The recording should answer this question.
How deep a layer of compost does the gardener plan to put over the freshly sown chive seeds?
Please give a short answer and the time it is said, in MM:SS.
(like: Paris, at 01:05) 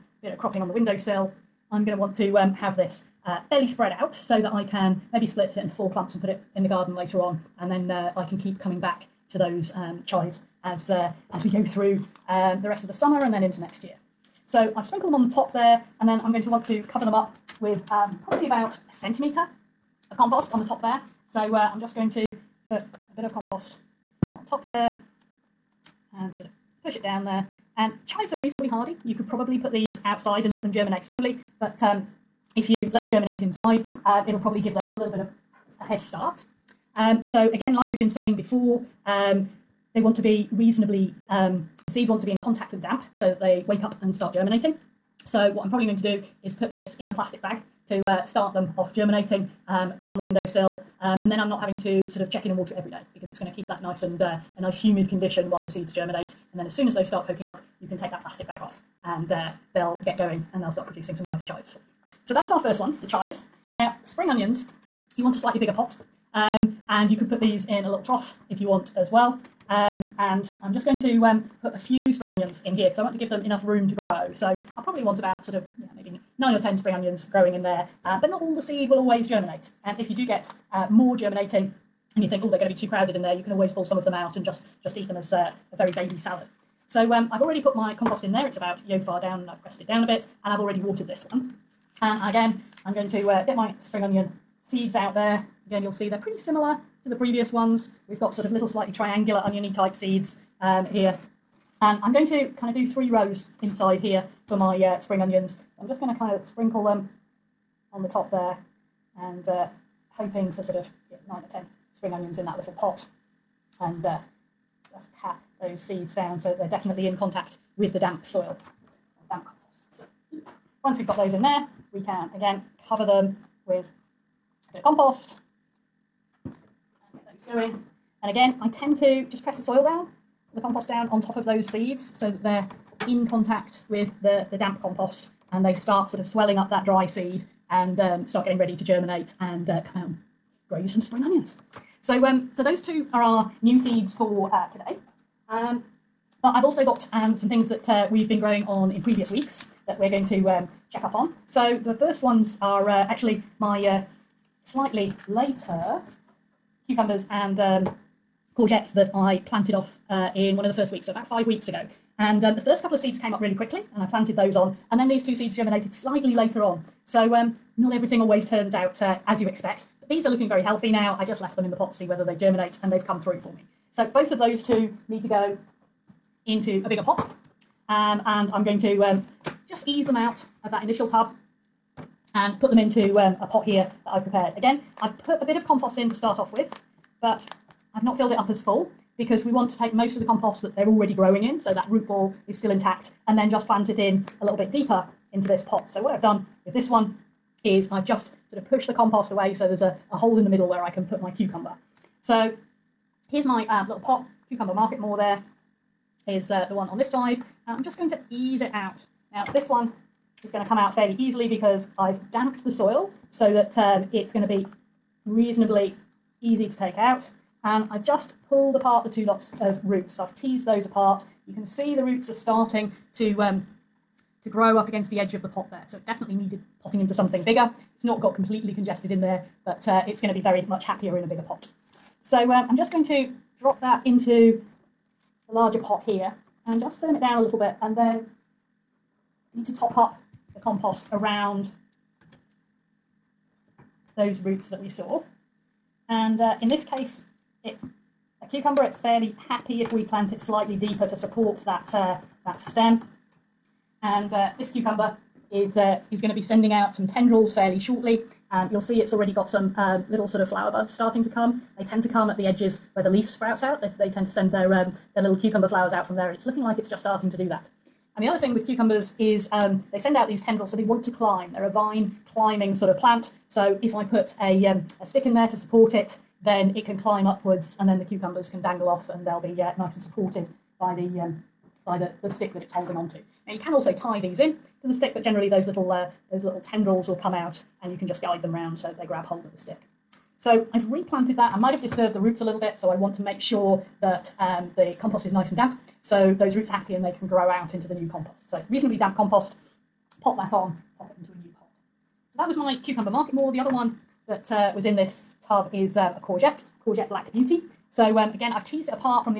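1 centimetre, at 00:18.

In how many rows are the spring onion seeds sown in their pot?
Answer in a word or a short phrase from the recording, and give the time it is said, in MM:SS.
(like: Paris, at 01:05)
3, at 01:42.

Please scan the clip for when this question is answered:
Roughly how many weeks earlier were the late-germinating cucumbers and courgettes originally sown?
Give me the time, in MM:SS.
02:41.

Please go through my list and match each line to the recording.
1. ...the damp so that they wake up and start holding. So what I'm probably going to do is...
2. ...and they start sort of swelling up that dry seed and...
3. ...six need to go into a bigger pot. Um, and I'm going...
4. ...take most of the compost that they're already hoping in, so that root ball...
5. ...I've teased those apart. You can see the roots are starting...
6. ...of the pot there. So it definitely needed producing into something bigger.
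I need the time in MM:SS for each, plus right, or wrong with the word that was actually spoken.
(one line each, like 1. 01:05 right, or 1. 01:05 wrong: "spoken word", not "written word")
1. 00:42 wrong: "germinating", not "holding"
2. 02:15 right
3. 02:54 wrong: "two", not "six"
4. 03:09 wrong: "growing", not "hoping"
5. 03:40 right
6. 03:45 wrong: "potting", not "producing".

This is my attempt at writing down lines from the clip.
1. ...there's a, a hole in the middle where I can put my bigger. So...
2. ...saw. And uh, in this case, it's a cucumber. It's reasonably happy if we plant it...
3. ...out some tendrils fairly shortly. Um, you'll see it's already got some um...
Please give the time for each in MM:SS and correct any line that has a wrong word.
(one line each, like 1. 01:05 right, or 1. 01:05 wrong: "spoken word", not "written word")
1. 03:19 wrong: "cucumber", not "bigger"
2. 04:04 wrong: "fairly", not "reasonably"
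3. 04:16 right.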